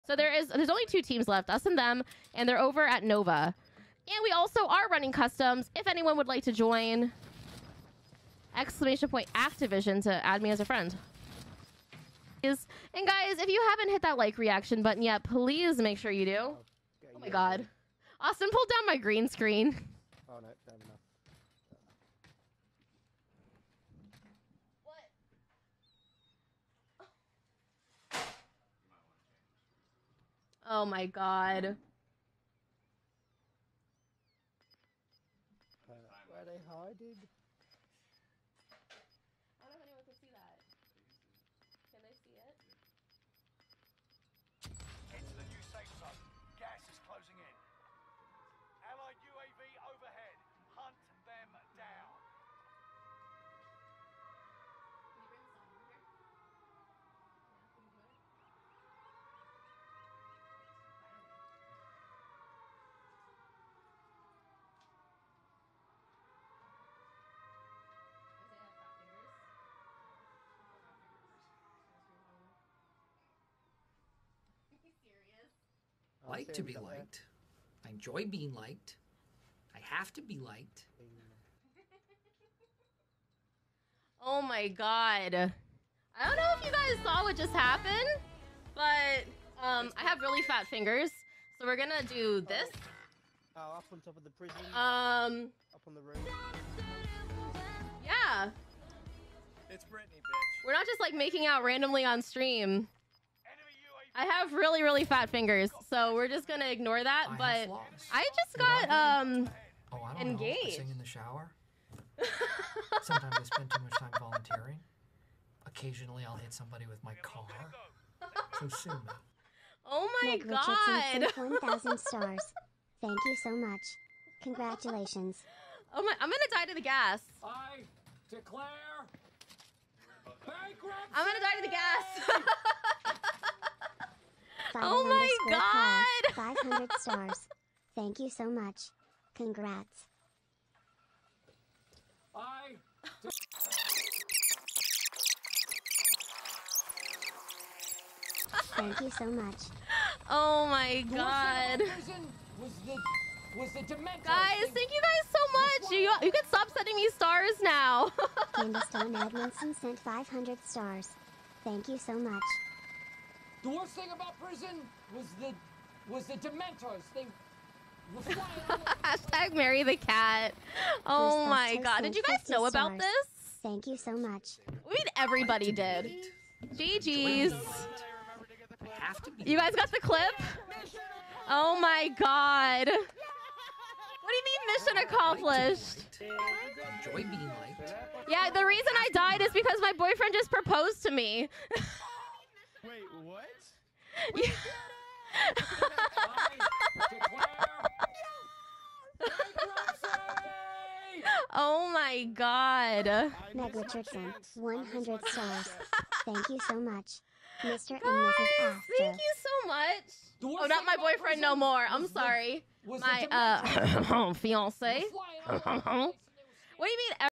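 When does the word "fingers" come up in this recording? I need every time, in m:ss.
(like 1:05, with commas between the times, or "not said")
1:30, 1:45.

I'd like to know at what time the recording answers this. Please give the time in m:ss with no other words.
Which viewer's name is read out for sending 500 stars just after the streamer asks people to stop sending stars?
2:38.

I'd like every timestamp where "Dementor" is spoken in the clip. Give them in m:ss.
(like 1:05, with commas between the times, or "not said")
2:33, 2:46.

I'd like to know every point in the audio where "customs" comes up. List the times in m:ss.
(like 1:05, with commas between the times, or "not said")
0:05.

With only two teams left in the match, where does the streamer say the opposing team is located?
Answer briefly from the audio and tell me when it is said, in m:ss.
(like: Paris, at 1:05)
Nova, at 0:03.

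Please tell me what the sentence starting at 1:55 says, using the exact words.
Occasionally, I'll hit somebody with my car.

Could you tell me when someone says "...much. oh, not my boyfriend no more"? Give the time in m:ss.
3:29.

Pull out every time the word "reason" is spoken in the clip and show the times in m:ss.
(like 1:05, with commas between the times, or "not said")
3:08.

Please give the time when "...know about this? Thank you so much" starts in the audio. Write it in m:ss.
2:52.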